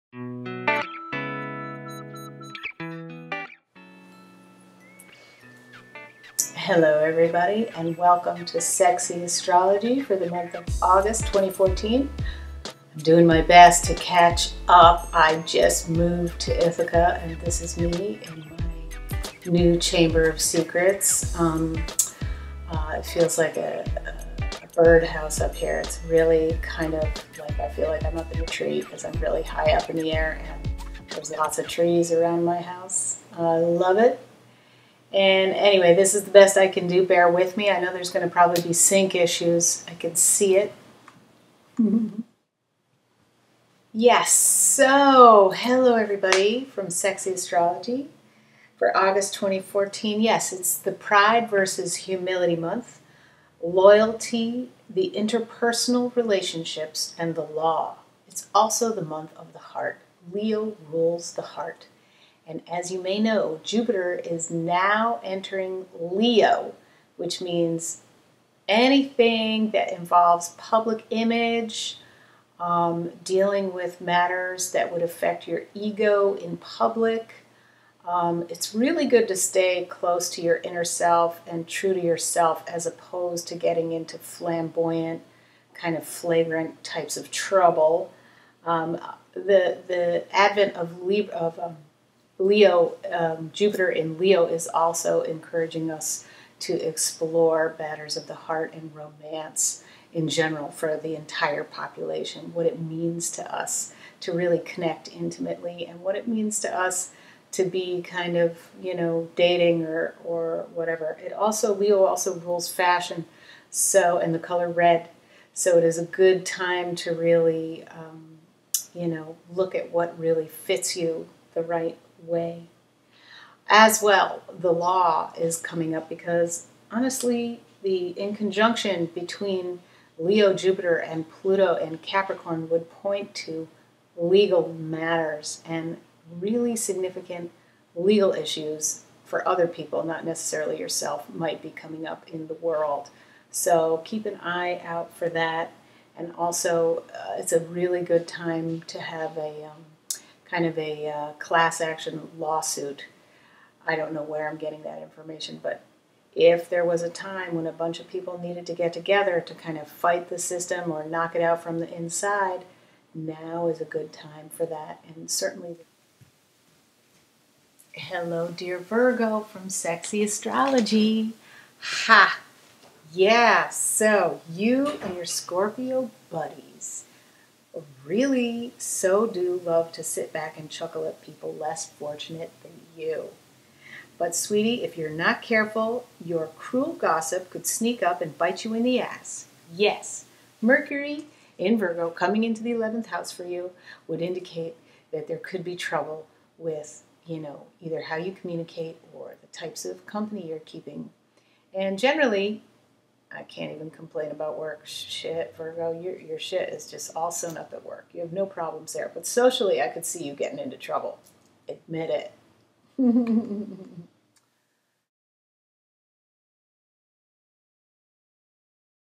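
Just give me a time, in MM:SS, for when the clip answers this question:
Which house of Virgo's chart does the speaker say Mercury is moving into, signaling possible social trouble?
03:12.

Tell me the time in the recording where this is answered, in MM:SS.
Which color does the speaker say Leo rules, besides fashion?
01:54.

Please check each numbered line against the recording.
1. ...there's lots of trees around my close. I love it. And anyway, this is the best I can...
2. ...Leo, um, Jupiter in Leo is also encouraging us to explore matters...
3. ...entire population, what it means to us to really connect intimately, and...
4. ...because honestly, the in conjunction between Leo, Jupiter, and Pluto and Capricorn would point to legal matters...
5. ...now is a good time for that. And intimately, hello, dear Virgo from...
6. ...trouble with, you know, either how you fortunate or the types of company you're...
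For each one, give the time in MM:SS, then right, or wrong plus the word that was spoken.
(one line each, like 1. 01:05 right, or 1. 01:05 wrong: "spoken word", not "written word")
1. 00:31 wrong: "house", not "close"
2. 01:32 right
3. 01:41 right
4. 02:06 right
5. 02:43 wrong: "certainly", not "intimately"
6. 03:15 wrong: "communicate", not "fortunate".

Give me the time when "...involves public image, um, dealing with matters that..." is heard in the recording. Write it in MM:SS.
01:09.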